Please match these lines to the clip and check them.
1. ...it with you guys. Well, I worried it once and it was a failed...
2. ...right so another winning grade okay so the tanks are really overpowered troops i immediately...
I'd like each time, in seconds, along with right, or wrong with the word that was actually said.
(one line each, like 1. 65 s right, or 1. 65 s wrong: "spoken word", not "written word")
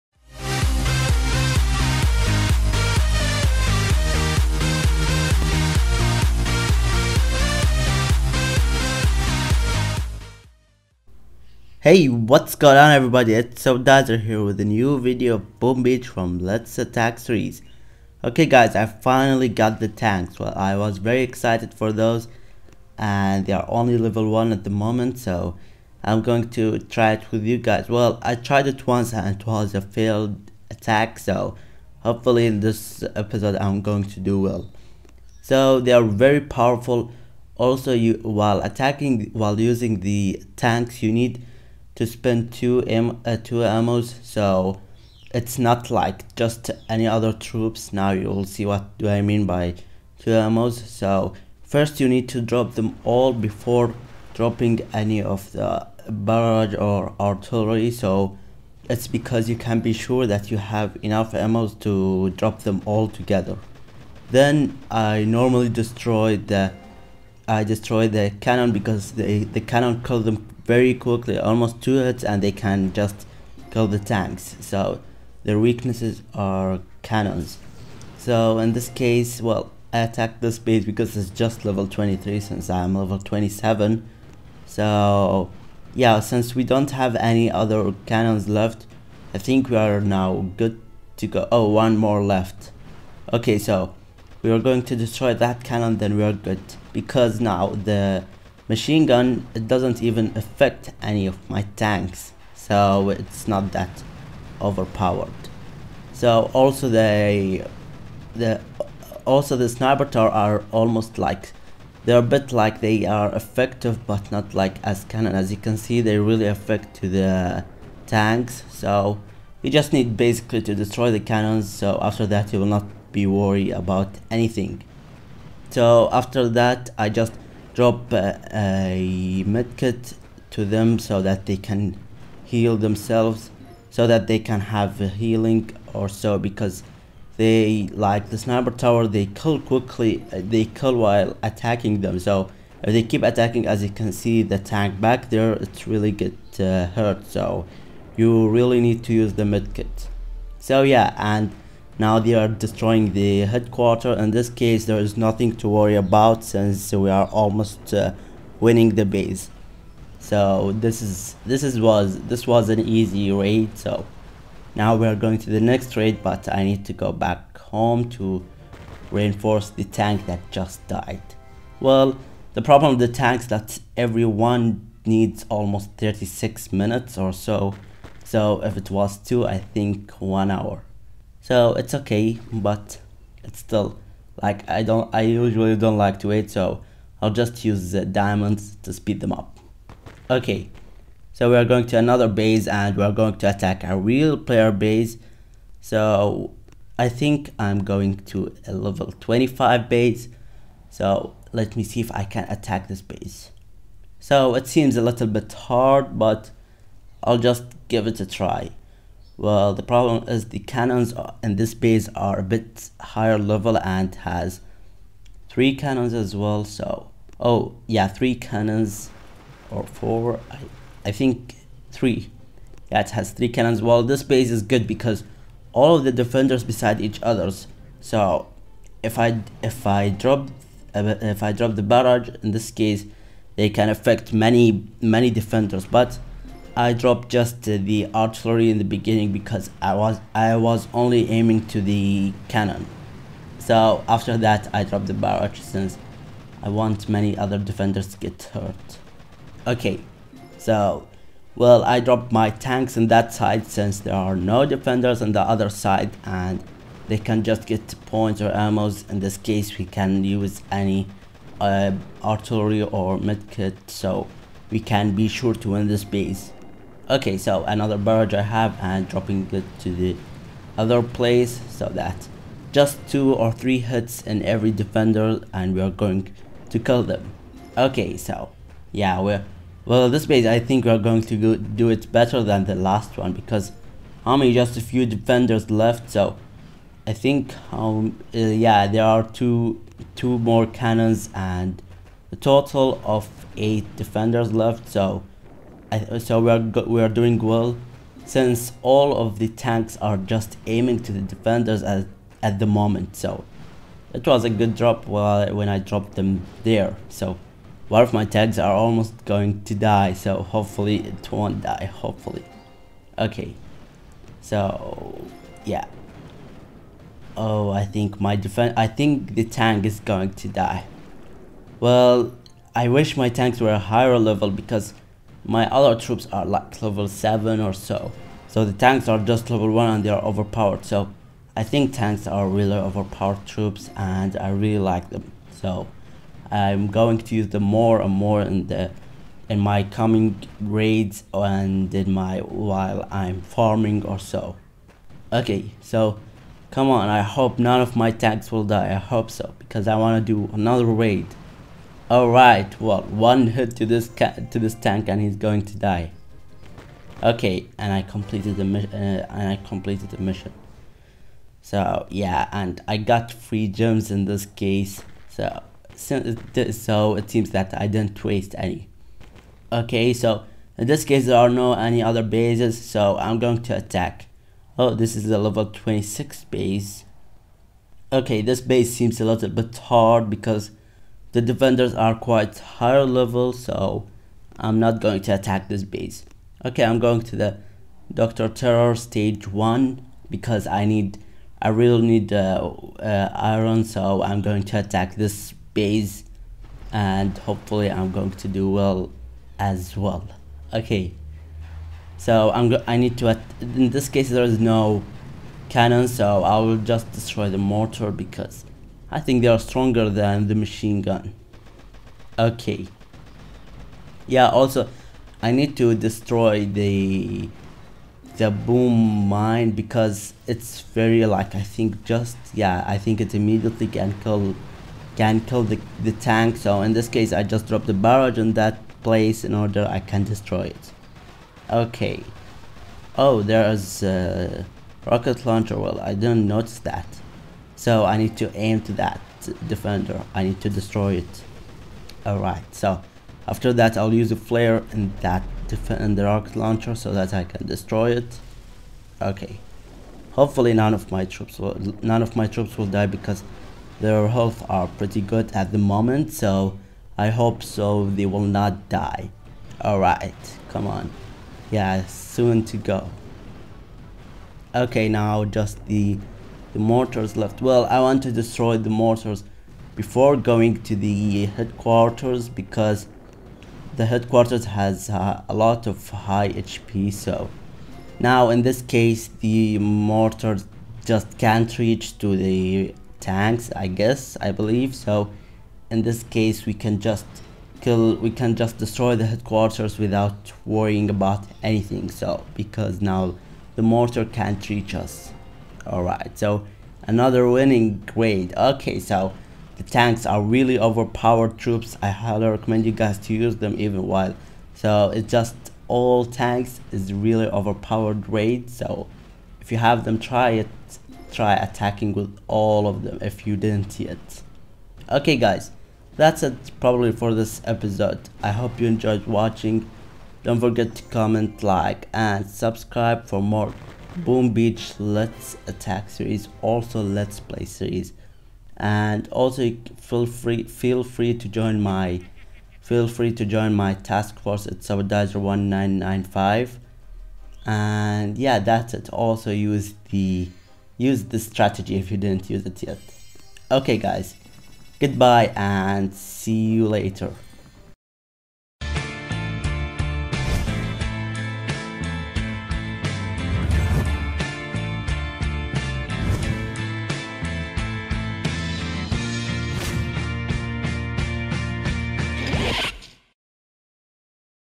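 1. 27 s wrong: "tried", not "worried"
2. 496 s wrong: "highly", not "immediately".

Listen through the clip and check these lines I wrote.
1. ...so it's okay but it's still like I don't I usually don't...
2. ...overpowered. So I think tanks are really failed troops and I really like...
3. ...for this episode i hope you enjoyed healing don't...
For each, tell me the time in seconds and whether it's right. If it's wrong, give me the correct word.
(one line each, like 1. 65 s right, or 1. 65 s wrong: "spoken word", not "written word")
1. 181 s right
2. 330 s wrong: "overpowered", not "failed"
3. 517 s wrong: "watching", not "healing".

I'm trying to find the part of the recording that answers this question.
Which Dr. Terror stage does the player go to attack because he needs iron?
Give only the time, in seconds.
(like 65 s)
388 s.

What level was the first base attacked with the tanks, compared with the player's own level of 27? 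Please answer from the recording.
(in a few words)
23.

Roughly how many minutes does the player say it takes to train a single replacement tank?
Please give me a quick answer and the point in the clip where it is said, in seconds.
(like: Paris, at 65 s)
36 minutes, at 175 s.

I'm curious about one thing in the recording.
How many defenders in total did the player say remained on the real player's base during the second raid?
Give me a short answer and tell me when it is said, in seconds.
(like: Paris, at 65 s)
8, at 292 s.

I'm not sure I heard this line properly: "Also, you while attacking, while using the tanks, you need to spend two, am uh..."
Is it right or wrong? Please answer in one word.
right.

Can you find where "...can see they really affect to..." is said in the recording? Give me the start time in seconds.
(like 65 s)
115 s.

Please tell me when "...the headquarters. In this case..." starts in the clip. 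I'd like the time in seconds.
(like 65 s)
153 s.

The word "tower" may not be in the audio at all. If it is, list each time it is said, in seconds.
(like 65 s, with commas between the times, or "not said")
110 s, 138 s.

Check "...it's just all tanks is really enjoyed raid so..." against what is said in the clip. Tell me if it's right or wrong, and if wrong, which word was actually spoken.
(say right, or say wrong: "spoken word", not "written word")
wrong: "overpowered", not "enjoyed".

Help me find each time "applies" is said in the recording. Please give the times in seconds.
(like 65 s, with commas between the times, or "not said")
not said.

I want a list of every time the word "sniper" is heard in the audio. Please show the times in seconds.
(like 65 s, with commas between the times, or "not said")
109 s, 138 s.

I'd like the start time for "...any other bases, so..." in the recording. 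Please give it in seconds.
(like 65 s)
371 s.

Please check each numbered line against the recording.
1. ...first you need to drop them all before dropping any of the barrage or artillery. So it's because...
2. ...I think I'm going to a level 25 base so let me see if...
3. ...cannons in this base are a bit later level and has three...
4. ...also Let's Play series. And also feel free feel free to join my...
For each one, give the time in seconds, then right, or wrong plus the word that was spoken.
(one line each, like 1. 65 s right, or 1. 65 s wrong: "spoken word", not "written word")
1. 51 s right
2. 196 s right
3. 210 s wrong: "higher", not "later"
4. 526 s right.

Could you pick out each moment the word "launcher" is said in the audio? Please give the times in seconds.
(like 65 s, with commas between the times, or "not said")
435 s, 446 s.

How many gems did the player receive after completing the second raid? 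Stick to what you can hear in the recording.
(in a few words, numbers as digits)
3.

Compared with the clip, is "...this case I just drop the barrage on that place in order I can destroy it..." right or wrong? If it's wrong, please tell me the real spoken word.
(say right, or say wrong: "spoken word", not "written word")
right.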